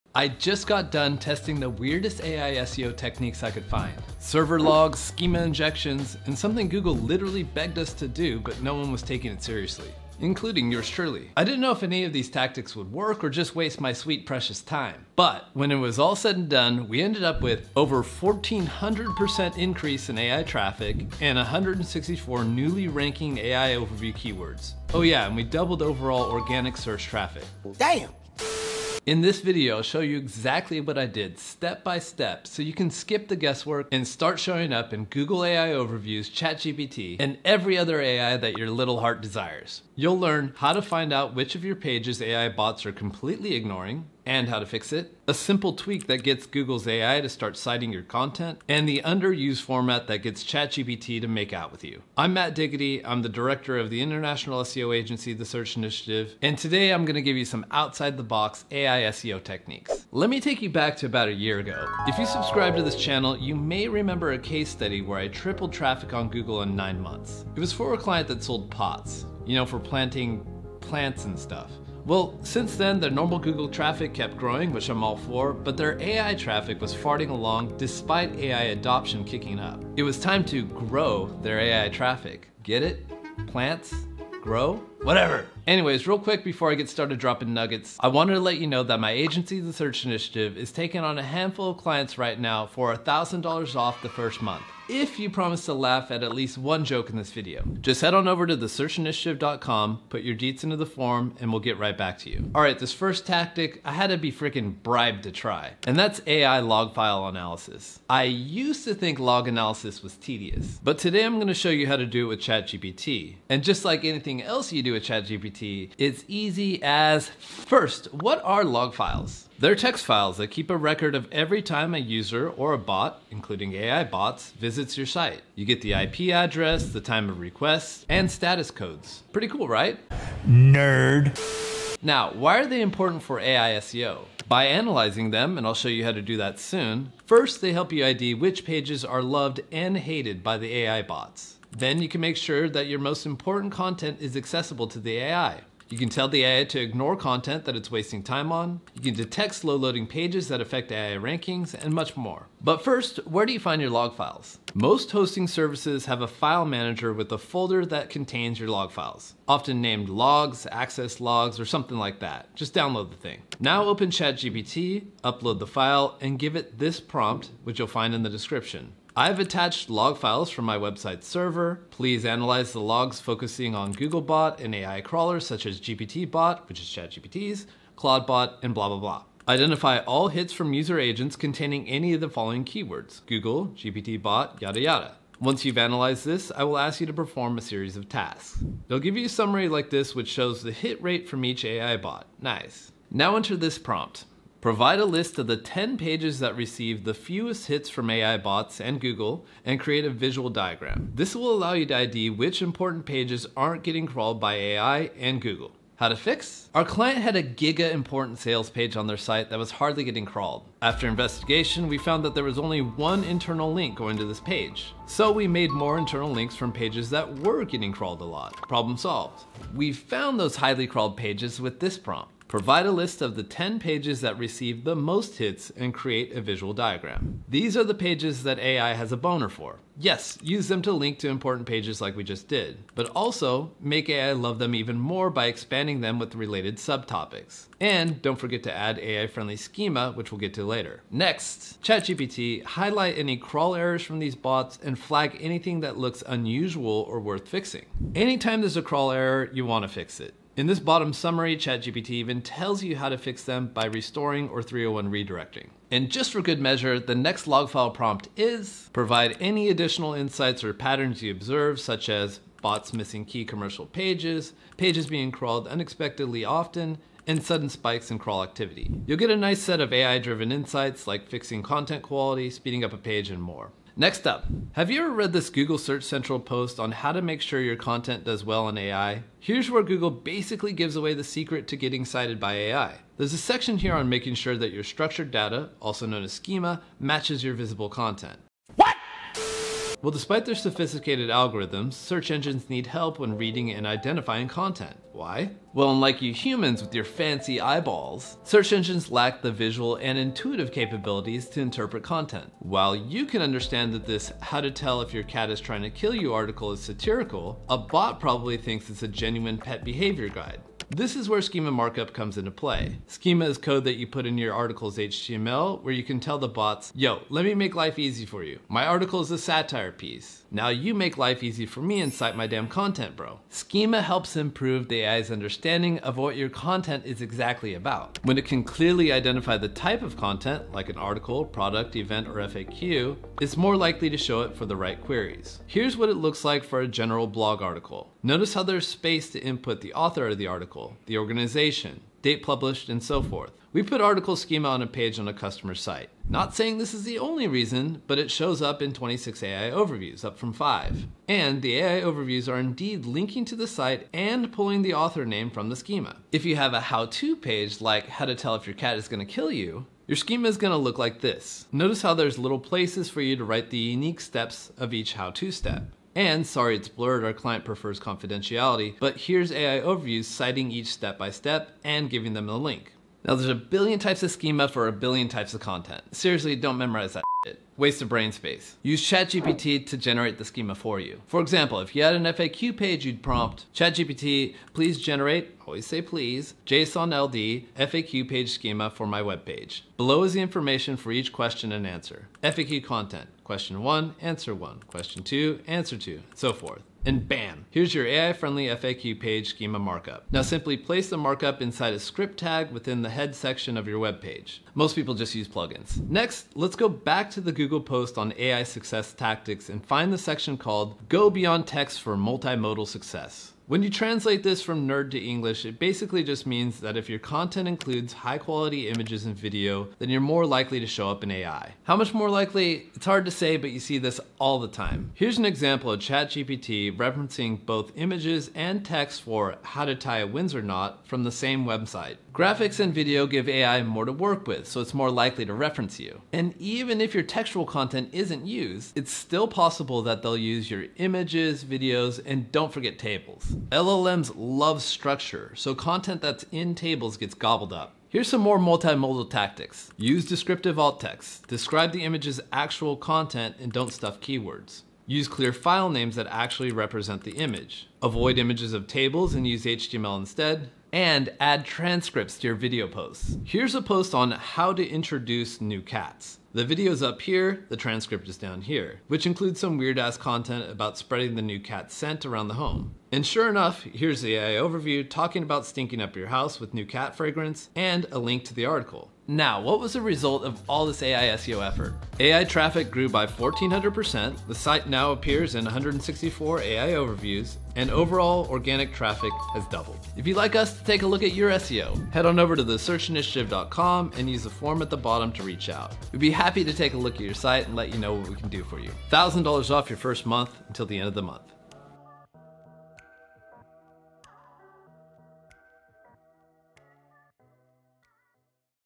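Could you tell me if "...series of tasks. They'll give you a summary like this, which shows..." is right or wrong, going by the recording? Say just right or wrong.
right.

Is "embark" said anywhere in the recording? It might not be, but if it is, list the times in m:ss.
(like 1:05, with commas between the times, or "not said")
not said.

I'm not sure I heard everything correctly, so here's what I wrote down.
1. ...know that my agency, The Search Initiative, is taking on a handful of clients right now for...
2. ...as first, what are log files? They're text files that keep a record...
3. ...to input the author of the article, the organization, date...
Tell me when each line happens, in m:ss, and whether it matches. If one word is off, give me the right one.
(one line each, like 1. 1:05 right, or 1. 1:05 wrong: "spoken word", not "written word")
1. 1:28 right
2. 1:56 right
3. 5:39 right.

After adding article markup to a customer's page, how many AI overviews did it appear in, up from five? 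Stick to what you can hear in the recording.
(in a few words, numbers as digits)
26.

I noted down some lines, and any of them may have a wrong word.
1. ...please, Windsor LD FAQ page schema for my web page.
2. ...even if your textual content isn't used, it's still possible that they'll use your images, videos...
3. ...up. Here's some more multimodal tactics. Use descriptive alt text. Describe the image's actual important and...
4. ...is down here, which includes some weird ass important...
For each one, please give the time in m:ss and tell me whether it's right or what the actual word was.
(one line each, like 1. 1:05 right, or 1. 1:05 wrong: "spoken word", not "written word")
1. 6:26 wrong: "JSON", not "Windsor"
2. 7:16 right
3. 7:27 wrong: "content", not "important"
4. 7:48 wrong: "content", not "important".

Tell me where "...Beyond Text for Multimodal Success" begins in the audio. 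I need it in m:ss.
6:51.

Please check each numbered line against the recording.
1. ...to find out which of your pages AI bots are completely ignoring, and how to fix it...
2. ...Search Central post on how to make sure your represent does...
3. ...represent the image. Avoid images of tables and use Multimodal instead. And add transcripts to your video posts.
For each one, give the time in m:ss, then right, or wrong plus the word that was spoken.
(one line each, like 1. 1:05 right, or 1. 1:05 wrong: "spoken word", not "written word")
1. 0:40 right
2. 4:35 wrong: "content", not "represent"
3. 7:36 wrong: "HTML", not "Multimodal".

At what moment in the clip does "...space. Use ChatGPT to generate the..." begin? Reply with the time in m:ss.
6:18.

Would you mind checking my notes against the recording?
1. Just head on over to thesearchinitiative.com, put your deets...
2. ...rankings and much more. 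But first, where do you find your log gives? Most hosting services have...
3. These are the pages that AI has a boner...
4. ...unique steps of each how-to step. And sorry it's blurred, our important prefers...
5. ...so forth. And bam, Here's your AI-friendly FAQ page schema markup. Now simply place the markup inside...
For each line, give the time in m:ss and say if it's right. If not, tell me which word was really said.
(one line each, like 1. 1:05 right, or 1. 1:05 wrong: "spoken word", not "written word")
1. 1:37 right
2. 2:31 wrong: "files", not "gives"
3. 3:47 right
4. 6:03 wrong: "client", not "important"
5. 6:36 right.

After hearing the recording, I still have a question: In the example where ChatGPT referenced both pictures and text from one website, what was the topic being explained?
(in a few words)
how to tie a Windsor knot.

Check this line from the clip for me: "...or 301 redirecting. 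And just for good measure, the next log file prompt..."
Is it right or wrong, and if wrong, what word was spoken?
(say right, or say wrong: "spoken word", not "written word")
right.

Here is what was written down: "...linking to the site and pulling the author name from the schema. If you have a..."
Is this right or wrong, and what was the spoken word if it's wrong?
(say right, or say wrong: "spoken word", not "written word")
right.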